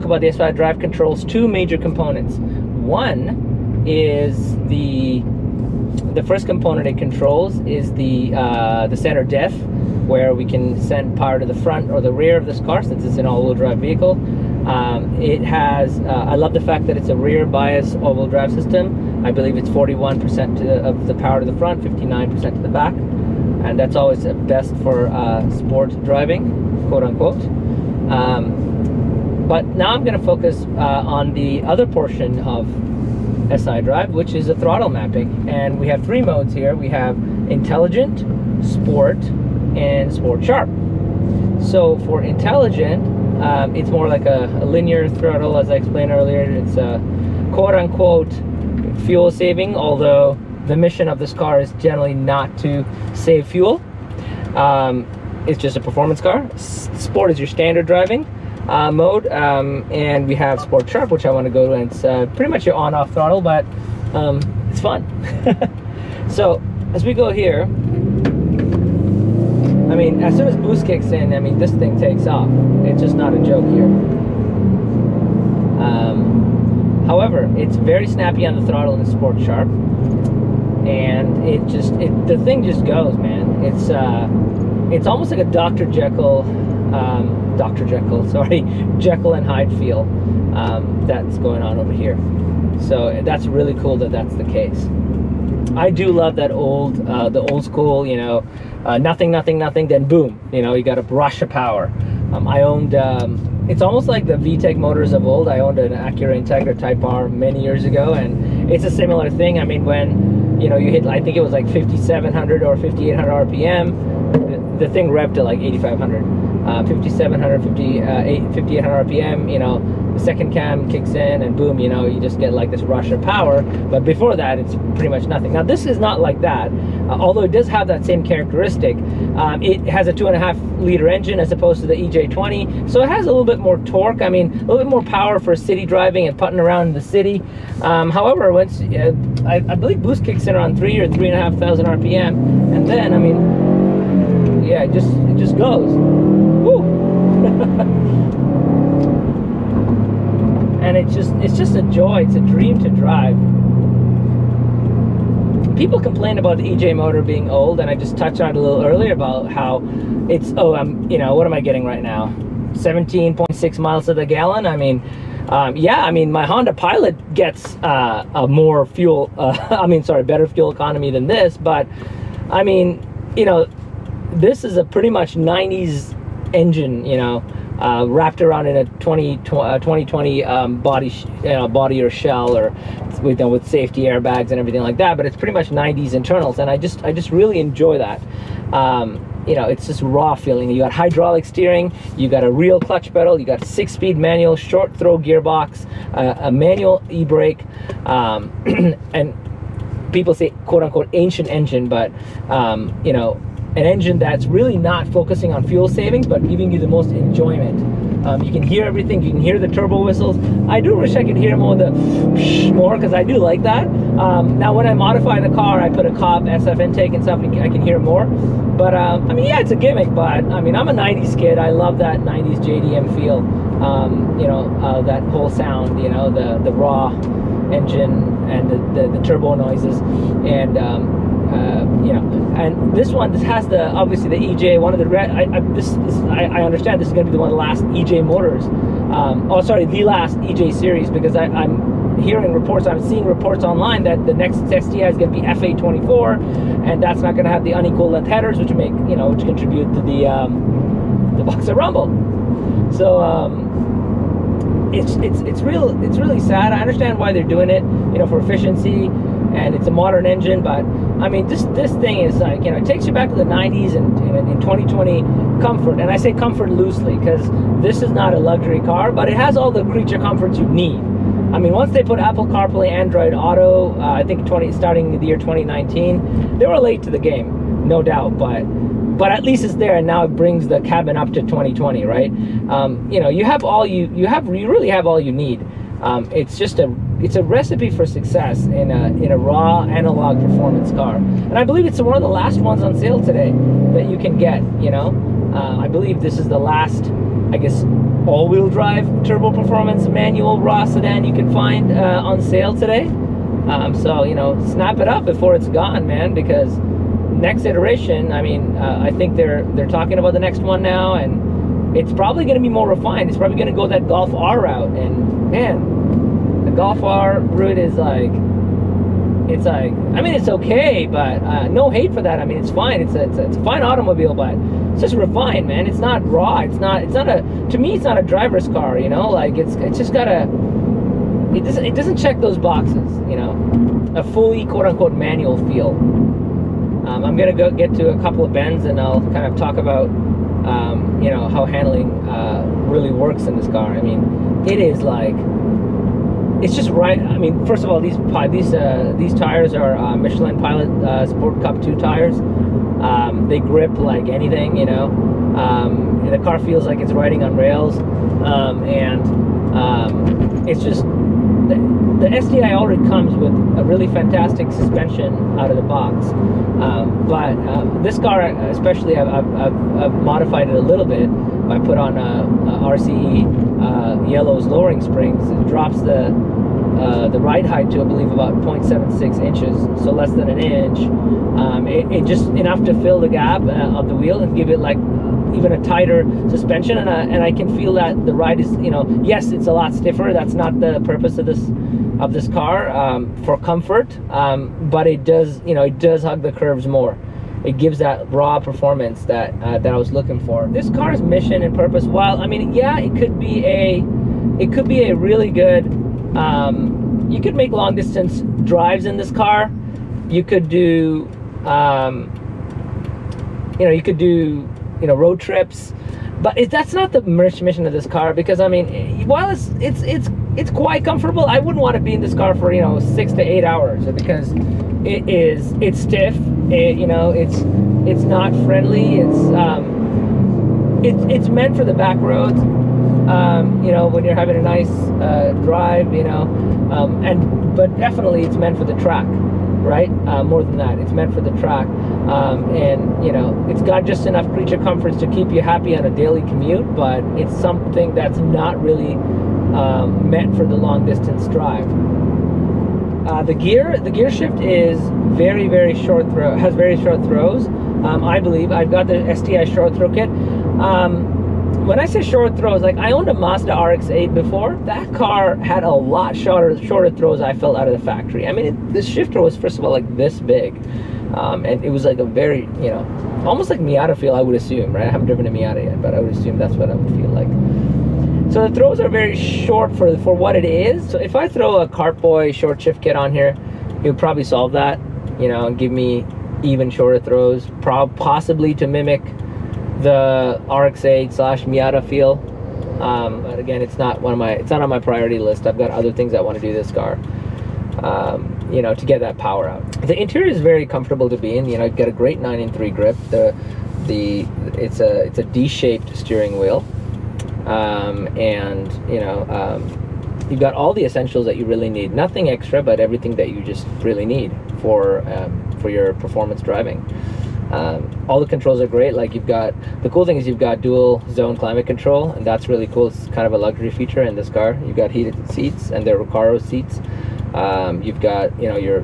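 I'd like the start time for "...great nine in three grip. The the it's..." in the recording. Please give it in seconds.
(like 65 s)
502 s.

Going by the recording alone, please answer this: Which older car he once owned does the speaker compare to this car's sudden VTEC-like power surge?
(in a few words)
Acura Integra Type R.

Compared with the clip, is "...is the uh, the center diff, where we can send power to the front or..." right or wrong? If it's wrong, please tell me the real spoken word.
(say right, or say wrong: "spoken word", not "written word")
right.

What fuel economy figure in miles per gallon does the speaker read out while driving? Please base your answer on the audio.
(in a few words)
17.6.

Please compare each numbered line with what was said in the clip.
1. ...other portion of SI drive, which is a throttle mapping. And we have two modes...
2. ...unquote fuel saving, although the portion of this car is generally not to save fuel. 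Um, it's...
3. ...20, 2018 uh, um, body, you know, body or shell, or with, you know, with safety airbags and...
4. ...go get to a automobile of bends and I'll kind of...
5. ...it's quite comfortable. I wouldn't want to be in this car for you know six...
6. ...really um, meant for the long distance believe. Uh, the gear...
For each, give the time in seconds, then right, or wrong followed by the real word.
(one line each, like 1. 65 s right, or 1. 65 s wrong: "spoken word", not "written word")
1. 31 s wrong: "three", not "two"
2. 47 s wrong: "mission", not "portion"
3. 178 s wrong: "2020", not "2018"
4. 337 s wrong: "couple", not "automobile"
5. 420 s right
6. 448 s wrong: "drive", not "believe".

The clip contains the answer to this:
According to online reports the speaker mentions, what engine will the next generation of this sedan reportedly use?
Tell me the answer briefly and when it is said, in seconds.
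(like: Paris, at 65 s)
FA24, at 245 s.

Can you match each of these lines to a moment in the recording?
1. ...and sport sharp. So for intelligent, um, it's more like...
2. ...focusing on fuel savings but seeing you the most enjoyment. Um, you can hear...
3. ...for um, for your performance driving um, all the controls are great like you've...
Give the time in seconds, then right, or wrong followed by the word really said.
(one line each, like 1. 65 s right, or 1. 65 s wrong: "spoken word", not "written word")
1. 39 s right
2. 205 s wrong: "giving", not "seeing"
3. 514 s right.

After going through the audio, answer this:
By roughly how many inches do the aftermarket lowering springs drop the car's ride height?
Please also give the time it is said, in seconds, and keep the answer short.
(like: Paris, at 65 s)
0.76 inches, at 378 s.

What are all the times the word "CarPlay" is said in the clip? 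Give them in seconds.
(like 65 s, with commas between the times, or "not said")
272 s.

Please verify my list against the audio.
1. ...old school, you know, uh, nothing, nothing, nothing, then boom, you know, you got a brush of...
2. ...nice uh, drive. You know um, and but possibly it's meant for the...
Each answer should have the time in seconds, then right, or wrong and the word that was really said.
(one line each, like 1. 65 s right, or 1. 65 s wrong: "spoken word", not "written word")
1. 97 s right
2. 434 s wrong: "definitely", not "possibly".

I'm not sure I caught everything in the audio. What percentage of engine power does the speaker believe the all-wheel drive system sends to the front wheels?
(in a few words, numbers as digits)
41%.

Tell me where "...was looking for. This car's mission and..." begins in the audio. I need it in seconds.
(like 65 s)
399 s.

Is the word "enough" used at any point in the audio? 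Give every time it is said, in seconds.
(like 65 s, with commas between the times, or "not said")
382 s, 444 s.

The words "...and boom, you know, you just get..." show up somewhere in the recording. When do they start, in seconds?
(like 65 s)
121 s.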